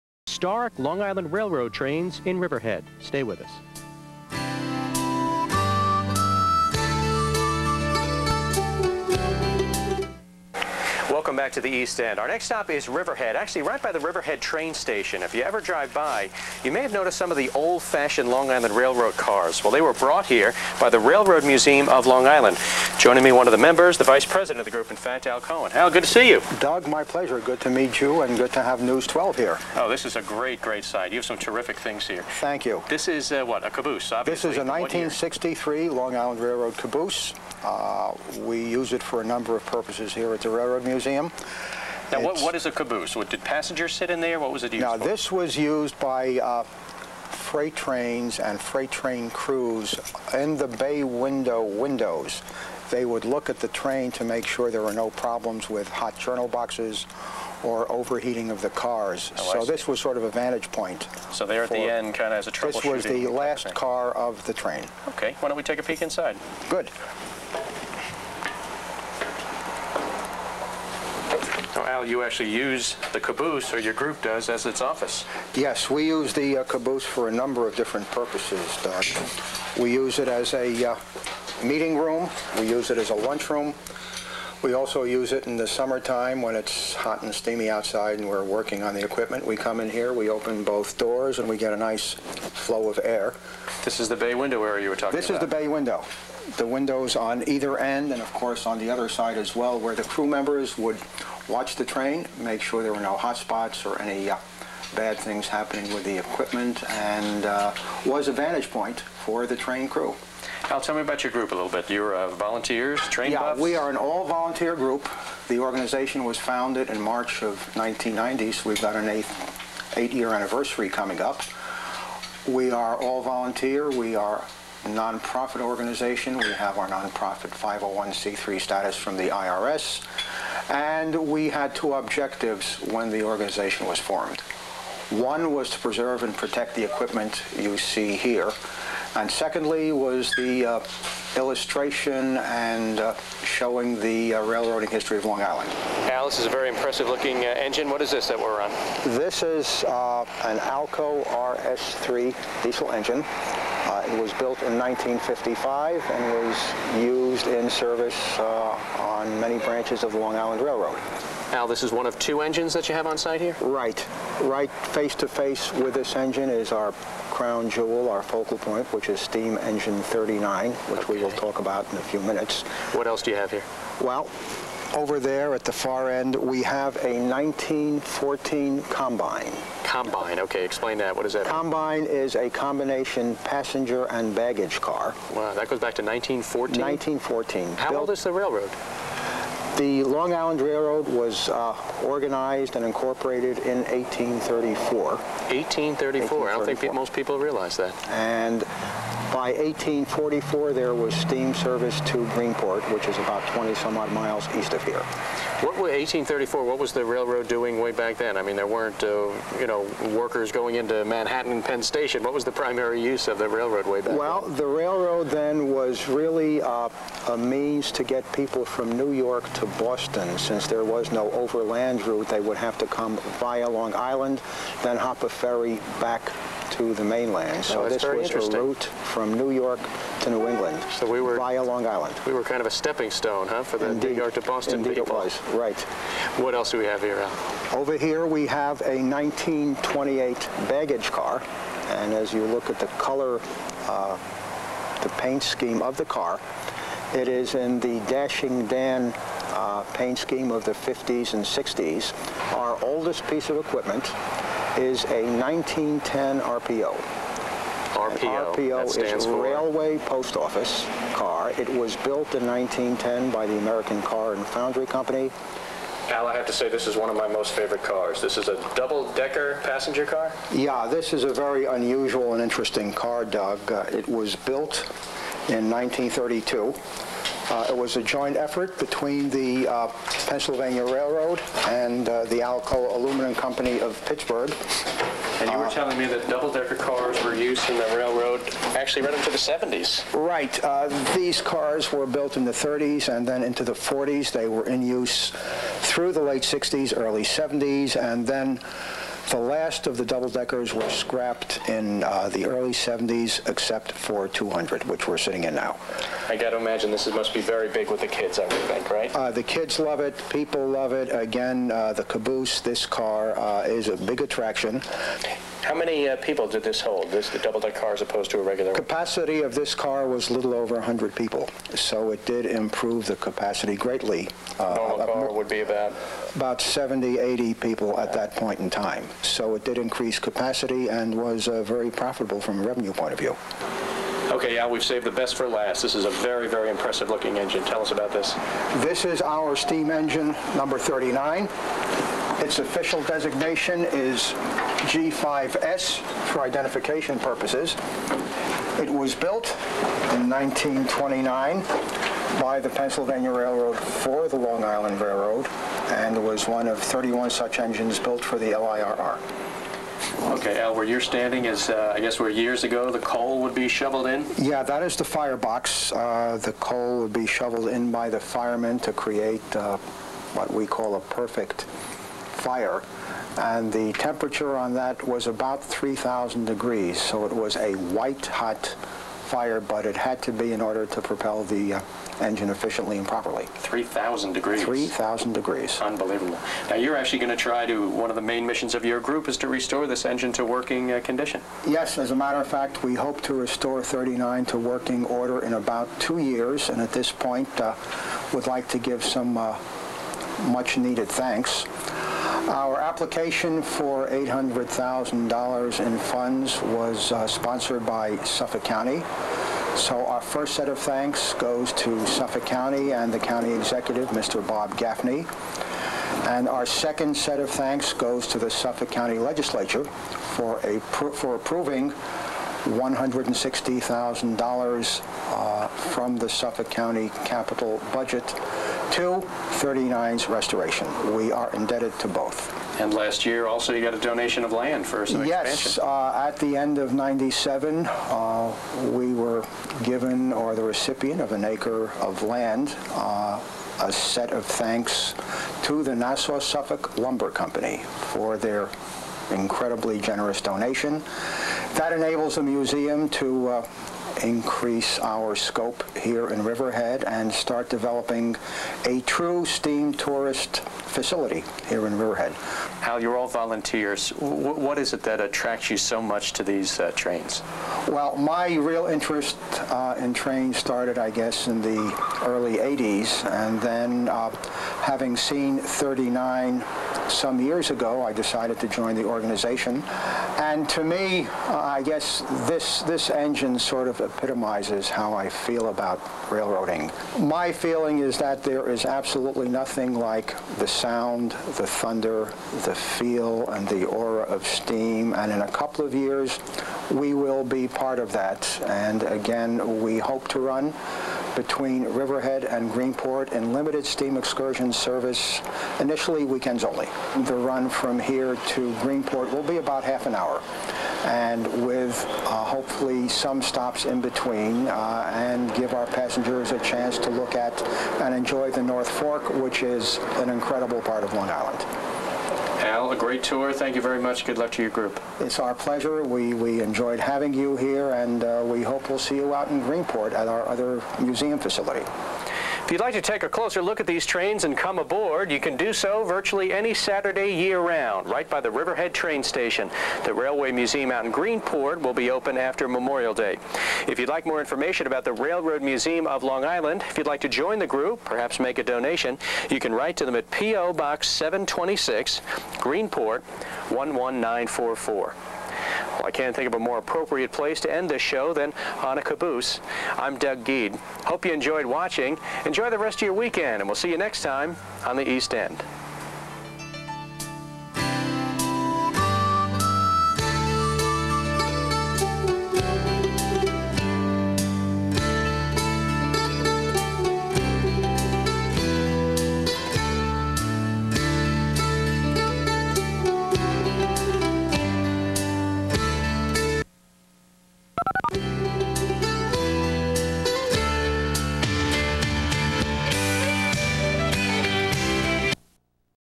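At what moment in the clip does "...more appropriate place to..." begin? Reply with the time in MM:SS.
09:16.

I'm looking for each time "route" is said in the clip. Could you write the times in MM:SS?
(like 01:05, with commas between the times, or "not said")
03:42, 03:48.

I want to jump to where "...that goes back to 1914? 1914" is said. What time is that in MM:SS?
03:05.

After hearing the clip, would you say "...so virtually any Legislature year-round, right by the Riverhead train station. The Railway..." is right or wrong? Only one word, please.
wrong.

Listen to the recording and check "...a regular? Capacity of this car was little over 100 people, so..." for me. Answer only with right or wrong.
right.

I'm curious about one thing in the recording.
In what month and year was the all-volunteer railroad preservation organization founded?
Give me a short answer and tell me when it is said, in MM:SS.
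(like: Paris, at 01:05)
March 1990, at 01:57.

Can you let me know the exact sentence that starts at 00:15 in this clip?
If you ever drive by, you may have noticed some of the old-fashioned Long Island Railroad cars.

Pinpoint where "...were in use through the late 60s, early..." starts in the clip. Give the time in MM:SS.
04:54.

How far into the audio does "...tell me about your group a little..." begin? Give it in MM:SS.
01:50.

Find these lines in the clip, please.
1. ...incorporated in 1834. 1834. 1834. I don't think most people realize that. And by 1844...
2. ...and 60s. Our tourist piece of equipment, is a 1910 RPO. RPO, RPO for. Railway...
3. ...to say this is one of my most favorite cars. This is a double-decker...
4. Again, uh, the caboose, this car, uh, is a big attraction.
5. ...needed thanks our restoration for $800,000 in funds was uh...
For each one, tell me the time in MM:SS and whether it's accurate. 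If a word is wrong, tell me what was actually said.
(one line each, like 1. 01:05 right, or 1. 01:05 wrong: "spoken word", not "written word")
1. 03:12 right
2. 04:11 wrong: "oldest", not "tourist"
3. 04:26 right
4. 05:11 right
5. 06:40 wrong: "application", not "restoration".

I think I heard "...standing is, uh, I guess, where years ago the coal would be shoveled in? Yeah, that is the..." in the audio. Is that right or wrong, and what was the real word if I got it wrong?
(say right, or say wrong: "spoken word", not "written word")
right.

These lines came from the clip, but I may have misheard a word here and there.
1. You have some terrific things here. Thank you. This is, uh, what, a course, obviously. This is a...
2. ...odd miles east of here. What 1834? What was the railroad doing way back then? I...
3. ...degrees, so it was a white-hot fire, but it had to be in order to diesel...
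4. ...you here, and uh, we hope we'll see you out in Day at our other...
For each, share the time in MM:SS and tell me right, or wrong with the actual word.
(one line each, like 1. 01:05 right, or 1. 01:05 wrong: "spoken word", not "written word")
1. 00:31 wrong: "caboose", not "course"
2. 03:23 right
3. 06:16 wrong: "propel", not "diesel"
4. 08:47 wrong: "Greenport", not "Day".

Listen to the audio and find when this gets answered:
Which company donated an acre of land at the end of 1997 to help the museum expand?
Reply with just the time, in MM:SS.
07:25.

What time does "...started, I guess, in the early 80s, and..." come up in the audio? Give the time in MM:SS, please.
07:50.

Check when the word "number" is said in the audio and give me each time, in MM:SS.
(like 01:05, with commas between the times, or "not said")
00:39, 01:17, 05:40.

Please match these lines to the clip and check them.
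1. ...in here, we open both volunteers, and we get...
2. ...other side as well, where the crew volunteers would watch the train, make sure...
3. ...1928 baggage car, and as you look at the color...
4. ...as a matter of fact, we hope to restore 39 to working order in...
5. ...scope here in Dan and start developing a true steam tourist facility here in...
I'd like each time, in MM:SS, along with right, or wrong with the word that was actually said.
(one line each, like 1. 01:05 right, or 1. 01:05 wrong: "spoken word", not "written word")
1. 01:29 wrong: "doors", not "volunteers"
2. 01:38 wrong: "members", not "volunteers"
3. 03:58 right
4. 06:31 right
5. 07:35 wrong: "Riverhead", not "Dan".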